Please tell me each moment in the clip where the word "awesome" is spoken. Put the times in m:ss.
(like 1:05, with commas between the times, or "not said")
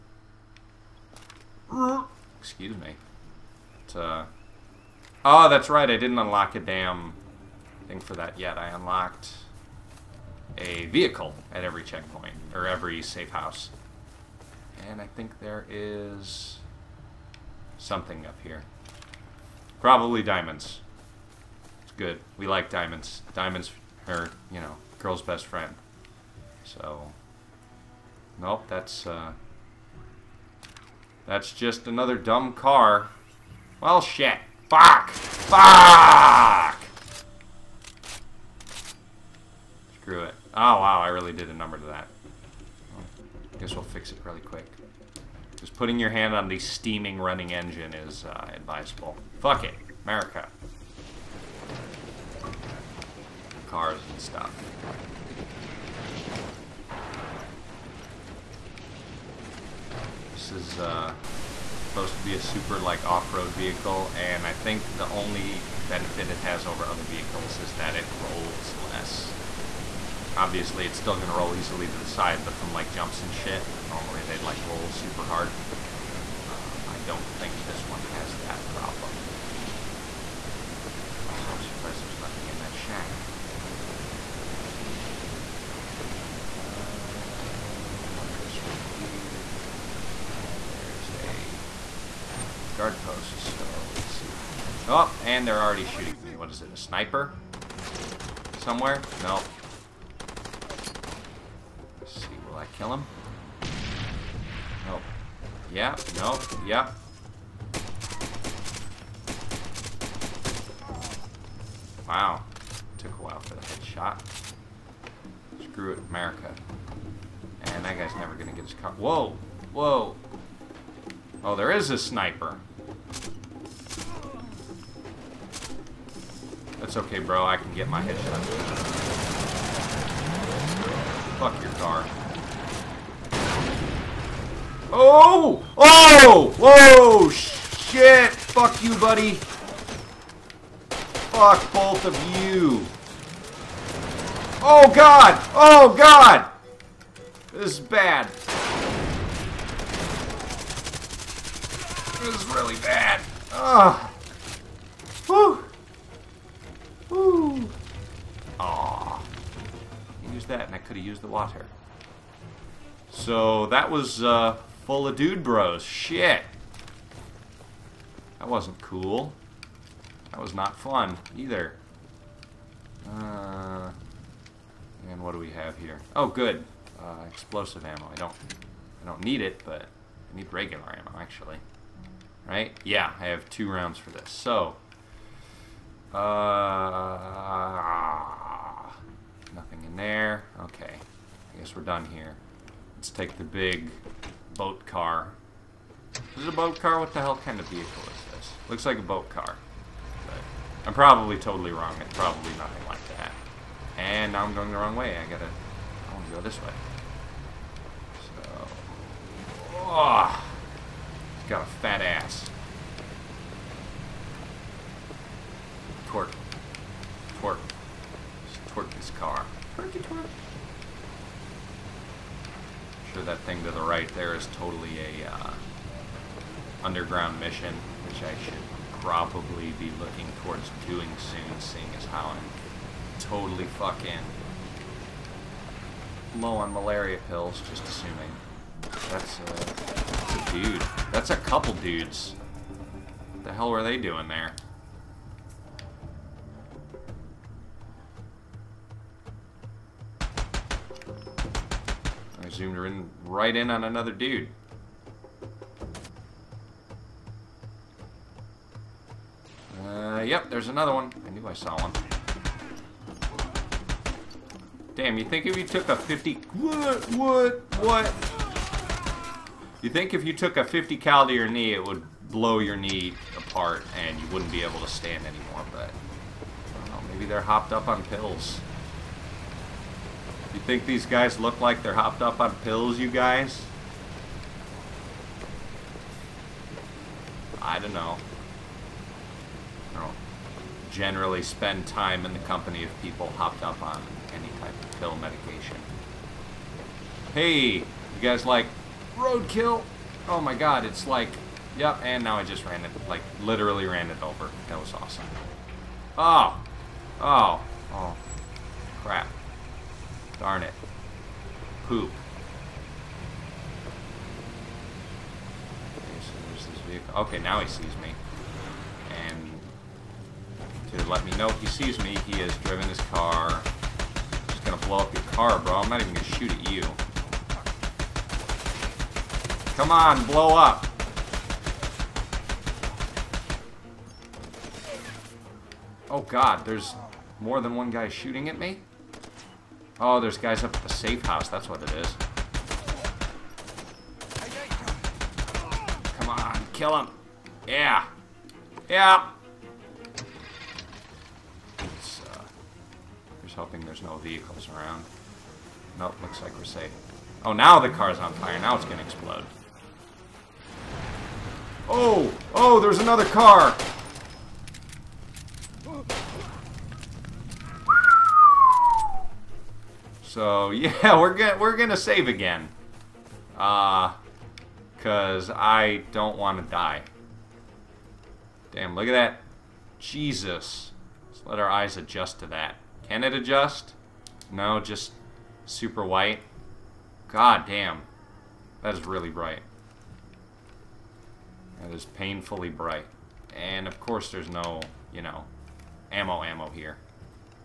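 5:04.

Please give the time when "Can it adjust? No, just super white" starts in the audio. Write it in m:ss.
6:23.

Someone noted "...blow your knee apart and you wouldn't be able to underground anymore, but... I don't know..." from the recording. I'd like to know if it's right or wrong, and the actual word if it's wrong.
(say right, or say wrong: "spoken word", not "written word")
wrong: "stand", not "underground".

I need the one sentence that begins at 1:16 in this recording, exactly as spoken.
Uh, I don't think this one has that problem.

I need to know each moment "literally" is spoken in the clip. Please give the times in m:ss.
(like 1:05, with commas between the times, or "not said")
5:03.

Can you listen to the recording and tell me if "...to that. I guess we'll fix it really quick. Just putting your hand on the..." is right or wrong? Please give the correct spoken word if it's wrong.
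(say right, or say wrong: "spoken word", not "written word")
right.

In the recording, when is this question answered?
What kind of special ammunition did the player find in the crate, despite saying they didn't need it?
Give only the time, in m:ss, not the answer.
2:57.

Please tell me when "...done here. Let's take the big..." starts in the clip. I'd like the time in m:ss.
3:11.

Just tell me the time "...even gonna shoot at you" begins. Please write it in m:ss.
5:26.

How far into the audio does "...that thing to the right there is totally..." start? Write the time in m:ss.
3:43.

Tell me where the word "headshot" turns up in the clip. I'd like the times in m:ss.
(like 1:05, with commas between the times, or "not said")
1:53, 2:08.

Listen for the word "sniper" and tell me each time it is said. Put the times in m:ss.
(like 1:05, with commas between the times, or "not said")
1:36, 2:01.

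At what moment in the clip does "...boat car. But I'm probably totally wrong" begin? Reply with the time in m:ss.
3:19.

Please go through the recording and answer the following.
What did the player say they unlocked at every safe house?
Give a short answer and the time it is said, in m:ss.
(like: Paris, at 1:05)
A vehicle, at 0:10.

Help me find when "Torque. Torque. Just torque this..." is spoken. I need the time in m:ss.
3:36.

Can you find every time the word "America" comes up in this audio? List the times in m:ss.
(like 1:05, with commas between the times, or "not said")
0:50, 1:56.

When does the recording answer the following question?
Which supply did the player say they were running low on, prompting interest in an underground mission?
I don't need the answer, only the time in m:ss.
3:56.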